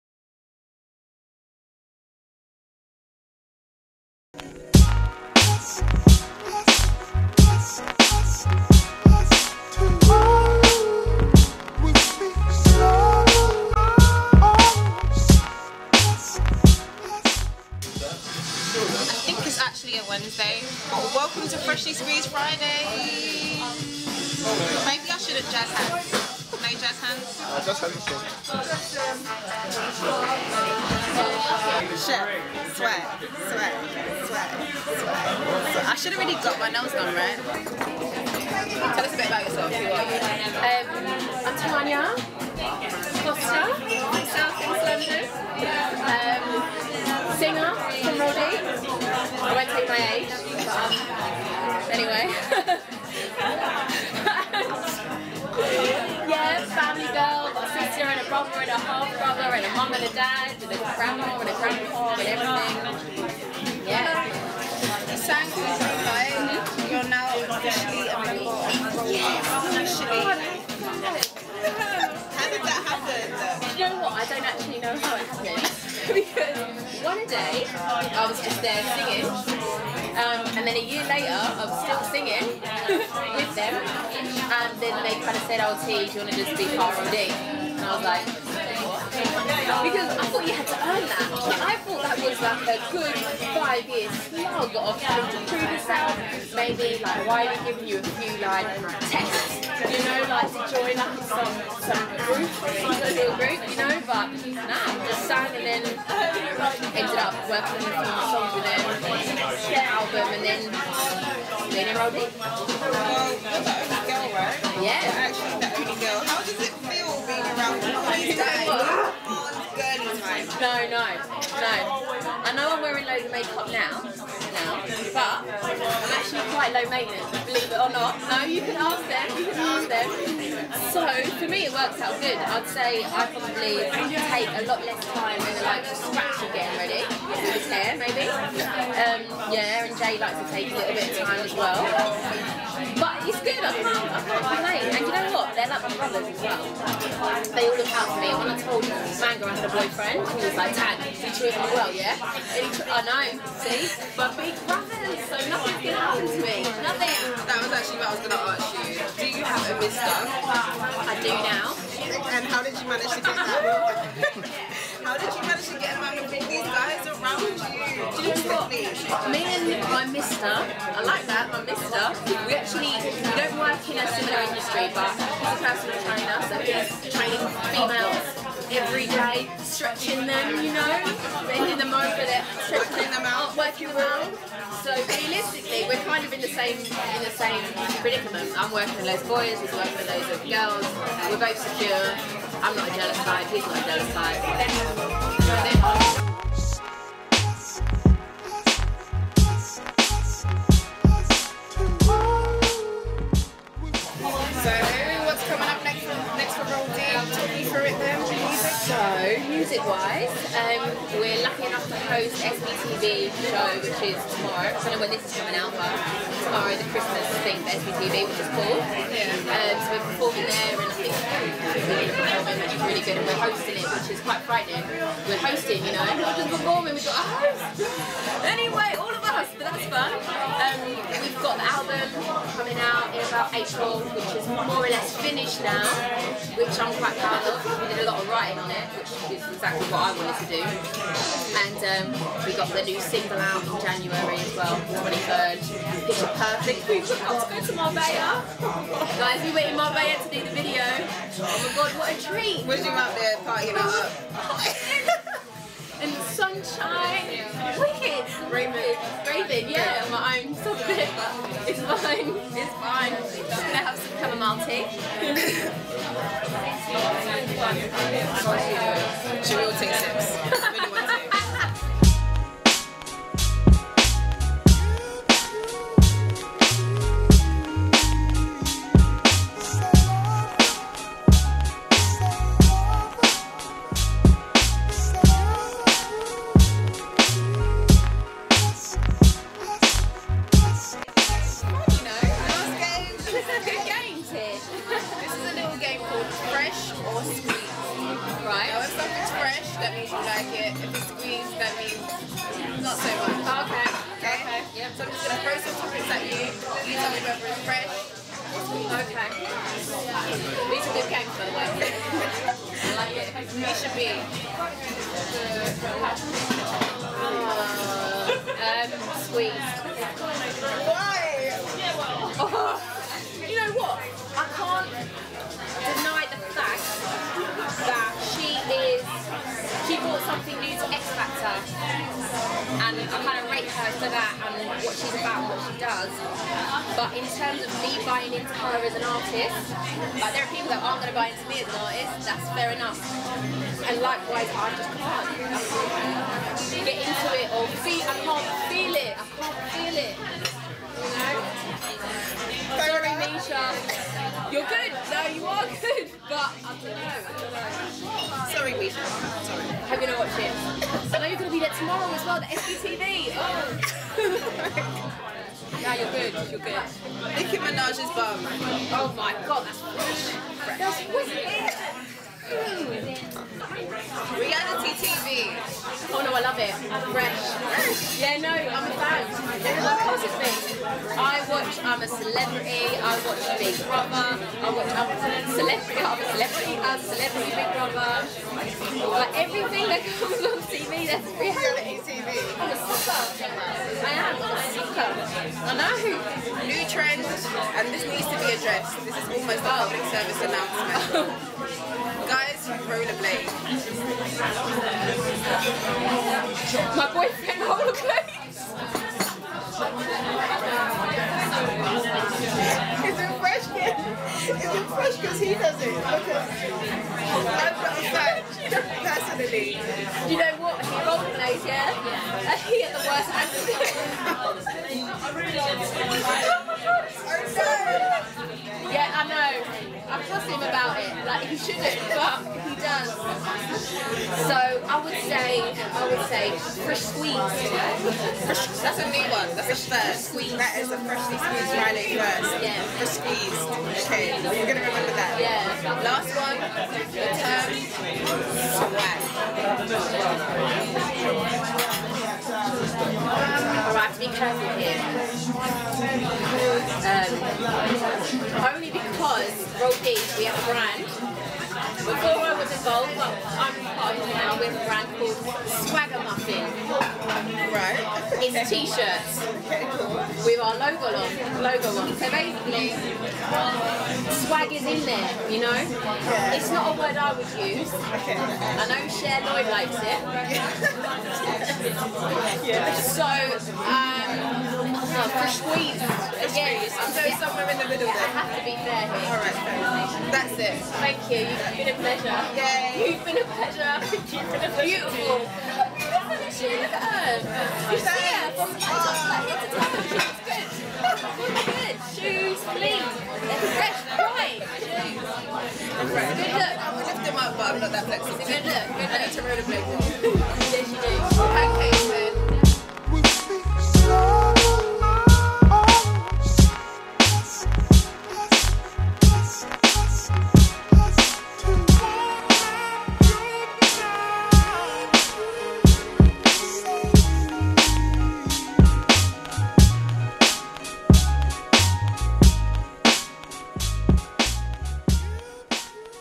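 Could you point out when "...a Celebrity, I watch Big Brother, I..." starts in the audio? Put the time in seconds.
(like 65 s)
382 s.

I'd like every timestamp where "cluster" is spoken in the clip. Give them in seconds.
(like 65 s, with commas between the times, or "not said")
not said.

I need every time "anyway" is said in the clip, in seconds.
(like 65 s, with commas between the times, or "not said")
51 s, 228 s.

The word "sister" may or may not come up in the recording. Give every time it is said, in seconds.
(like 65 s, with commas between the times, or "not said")
57 s.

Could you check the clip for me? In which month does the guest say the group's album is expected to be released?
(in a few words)
April.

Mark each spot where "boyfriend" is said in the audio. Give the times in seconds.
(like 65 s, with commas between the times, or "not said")
149 s, 407 s.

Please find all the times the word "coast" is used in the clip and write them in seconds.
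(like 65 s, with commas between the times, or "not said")
not said.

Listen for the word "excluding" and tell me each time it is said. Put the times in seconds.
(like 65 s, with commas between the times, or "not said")
not said.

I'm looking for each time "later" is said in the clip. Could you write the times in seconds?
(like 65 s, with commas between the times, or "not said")
81 s.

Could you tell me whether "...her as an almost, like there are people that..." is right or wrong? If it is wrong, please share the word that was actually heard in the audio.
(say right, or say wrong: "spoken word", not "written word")
wrong: "artist", not "almost".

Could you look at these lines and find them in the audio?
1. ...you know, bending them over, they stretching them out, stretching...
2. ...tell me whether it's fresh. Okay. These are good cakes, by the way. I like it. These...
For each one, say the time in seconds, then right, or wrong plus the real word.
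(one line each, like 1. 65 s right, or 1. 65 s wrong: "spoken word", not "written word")
1. 180 s wrong: "working", not "stretching"
2. 306 s right.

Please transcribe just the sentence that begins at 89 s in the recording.
Because I thought you had to earn that.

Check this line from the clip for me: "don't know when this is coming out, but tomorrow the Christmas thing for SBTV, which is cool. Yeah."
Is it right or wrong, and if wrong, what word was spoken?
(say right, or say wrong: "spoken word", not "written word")
right.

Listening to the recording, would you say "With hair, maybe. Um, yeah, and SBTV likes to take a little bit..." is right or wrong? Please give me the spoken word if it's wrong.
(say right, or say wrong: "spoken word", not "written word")
wrong: "Jay", not "SBTV".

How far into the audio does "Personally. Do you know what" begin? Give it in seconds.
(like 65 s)
418 s.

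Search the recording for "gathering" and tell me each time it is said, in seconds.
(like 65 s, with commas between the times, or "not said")
not said.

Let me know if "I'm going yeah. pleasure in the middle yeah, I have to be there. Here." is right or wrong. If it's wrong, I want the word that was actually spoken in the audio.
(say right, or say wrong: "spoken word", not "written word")
wrong: "somewhere", not "pleasure".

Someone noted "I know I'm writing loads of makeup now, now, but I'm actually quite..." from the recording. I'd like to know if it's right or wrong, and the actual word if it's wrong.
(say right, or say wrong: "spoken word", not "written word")
wrong: "wearing", not "writing".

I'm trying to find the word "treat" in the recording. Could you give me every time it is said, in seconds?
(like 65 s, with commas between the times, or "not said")
151 s, 252 s.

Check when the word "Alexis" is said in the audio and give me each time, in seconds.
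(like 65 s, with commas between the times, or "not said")
not said.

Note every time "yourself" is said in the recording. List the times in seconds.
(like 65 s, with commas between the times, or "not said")
39 s, 95 s.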